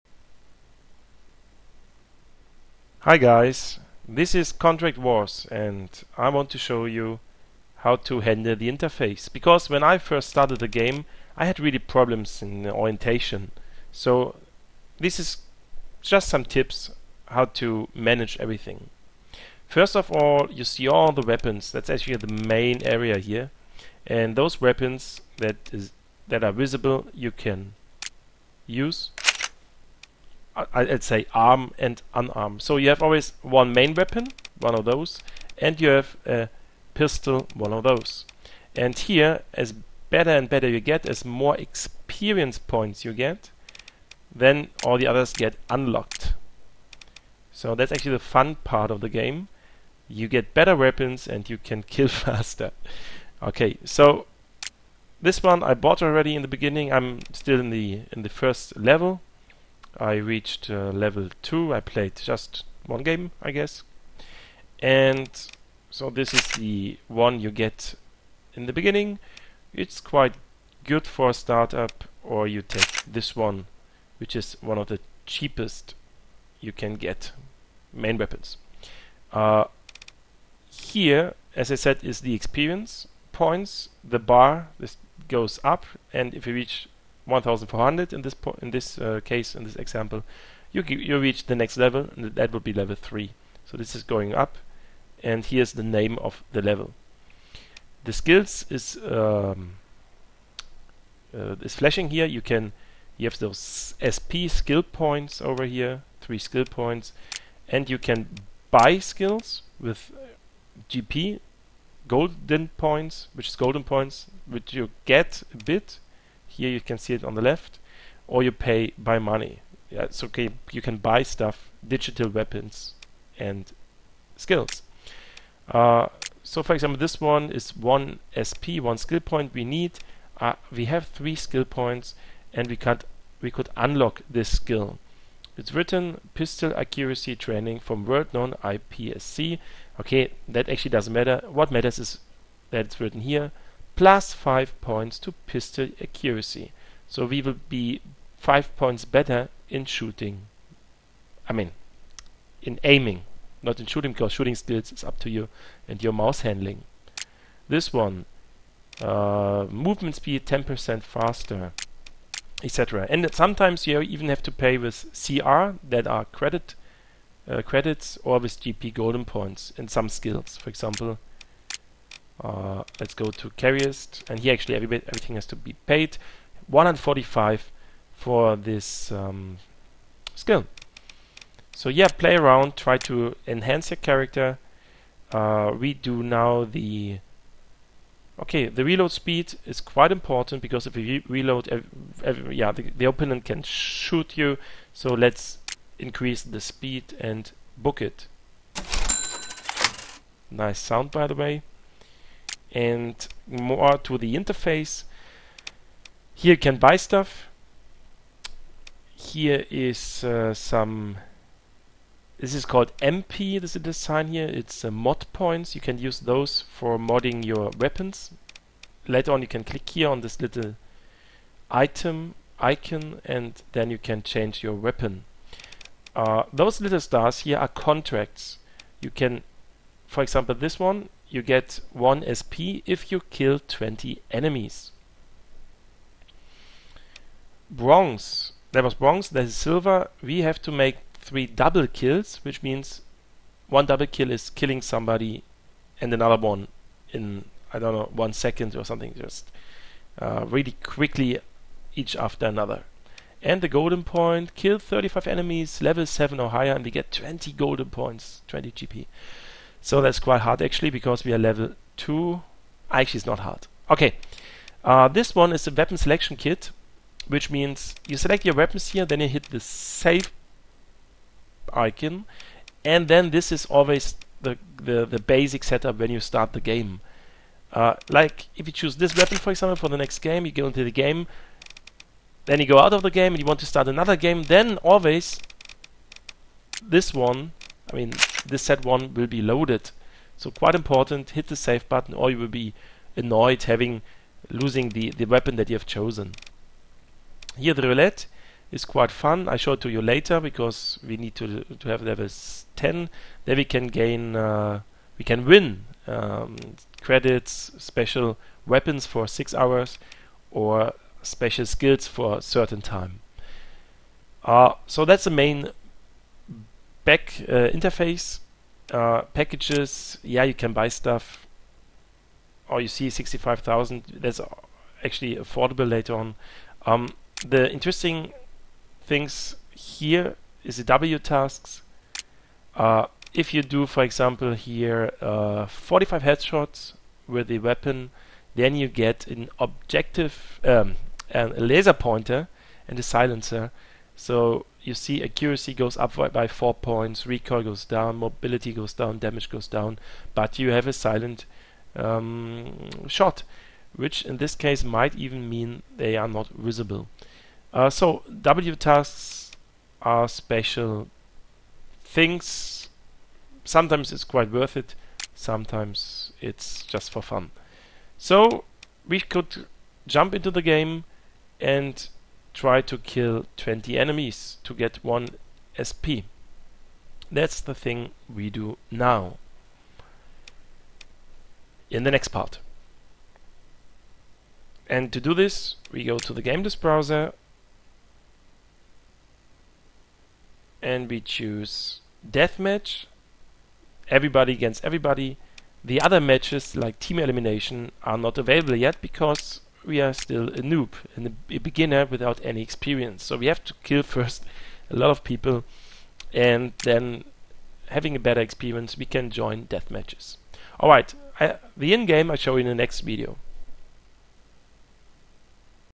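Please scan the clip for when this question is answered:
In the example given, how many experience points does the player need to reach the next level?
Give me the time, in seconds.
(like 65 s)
87 s.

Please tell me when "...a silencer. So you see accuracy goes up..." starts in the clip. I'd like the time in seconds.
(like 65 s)
342 s.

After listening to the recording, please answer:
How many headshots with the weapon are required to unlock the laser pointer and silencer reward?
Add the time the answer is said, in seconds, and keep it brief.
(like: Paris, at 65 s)
45, at 335 s.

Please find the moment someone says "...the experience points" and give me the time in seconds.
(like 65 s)
82 s.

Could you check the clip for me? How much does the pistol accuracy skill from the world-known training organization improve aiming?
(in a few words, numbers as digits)
5 points.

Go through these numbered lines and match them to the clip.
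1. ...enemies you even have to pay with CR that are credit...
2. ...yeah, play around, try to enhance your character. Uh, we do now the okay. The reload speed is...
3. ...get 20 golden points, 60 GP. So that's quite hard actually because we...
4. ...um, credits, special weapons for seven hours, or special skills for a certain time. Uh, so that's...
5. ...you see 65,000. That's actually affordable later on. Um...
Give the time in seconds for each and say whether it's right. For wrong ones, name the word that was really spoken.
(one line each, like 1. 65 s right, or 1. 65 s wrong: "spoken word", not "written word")
1. 163 s wrong: "sometimes", not "enemies"
2. 181 s right
3. 256 s wrong: "20", not "60"
4. 306 s wrong: "six", not "seven"
5. 322 s right.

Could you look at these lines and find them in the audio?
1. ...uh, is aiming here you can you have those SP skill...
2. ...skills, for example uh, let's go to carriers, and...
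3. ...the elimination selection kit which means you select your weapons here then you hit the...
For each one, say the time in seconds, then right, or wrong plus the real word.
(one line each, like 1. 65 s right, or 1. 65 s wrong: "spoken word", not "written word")
1. 101 s wrong: "flashing", not "aiming"
2. 170 s right
3. 265 s wrong: "weapon", not "elimination".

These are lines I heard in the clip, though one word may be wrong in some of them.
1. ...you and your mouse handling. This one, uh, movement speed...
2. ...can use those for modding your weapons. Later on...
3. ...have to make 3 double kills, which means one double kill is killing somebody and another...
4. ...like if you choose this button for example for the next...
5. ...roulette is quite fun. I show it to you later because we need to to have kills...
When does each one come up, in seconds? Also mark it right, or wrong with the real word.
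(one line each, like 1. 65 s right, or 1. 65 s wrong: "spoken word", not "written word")
1. 155 s right
2. 215 s right
3. 240 s right
4. 278 s wrong: "weapon", not "button"
5. 297 s wrong: "levels", not "kills".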